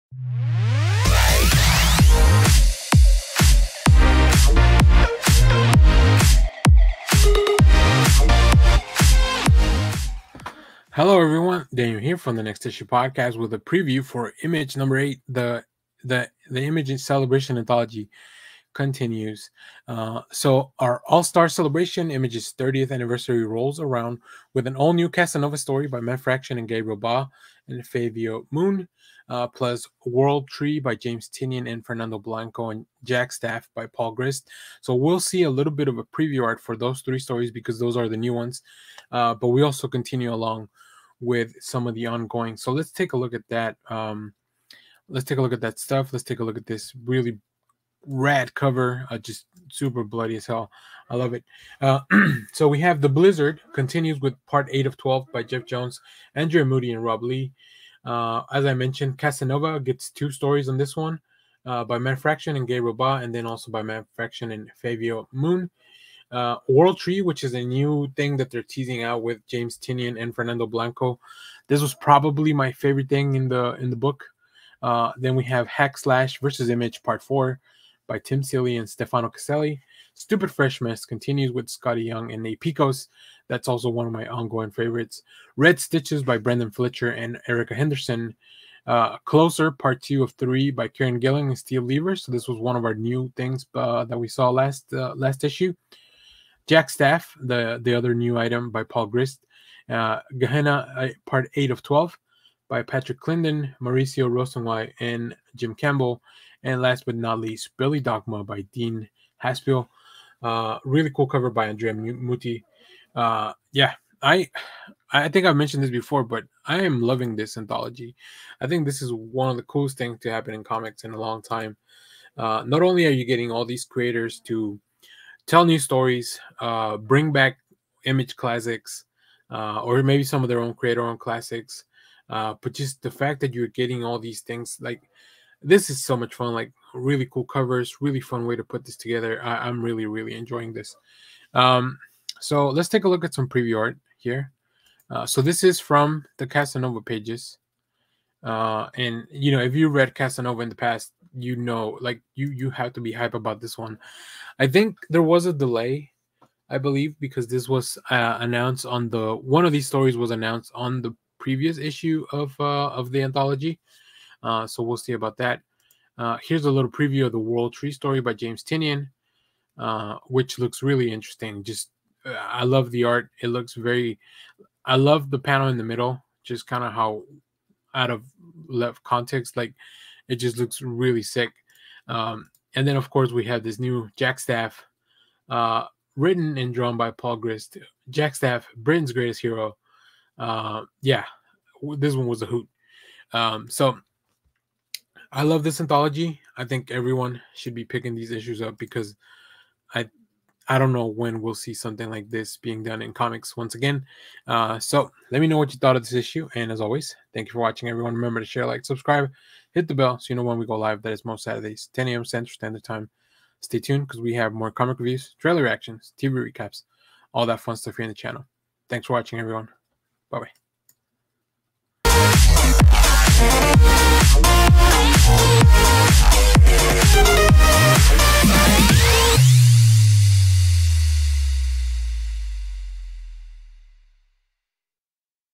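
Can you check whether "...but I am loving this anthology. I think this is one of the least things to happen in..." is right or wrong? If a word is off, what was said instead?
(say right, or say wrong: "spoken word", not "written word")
wrong: "coolest", not "least".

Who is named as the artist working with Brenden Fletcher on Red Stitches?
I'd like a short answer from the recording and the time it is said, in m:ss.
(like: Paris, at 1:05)
Erica Henderson, at 1:27.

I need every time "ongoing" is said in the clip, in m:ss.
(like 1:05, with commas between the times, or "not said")
0:42, 1:24.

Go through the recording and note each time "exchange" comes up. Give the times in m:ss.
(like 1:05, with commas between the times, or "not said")
not said.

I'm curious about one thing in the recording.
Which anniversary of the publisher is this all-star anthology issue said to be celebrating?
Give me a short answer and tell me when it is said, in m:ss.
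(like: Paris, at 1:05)
30th, at 0:22.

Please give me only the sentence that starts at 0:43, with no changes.
Um, let's take a look at that stuff.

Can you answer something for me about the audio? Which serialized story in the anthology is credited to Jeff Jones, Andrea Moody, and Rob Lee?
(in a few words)
The Blizzard.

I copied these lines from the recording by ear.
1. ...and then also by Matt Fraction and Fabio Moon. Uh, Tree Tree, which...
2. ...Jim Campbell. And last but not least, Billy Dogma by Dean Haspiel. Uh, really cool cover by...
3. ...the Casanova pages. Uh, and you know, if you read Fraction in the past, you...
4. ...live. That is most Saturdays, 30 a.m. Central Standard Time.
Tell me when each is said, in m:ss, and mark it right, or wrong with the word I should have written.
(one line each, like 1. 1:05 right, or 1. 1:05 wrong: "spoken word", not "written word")
1. 1:03 wrong: "World", not "Tree"
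2. 1:45 right
3. 2:26 wrong: "Casanova", not "Fraction"
4. 3:30 wrong: "10", not "30".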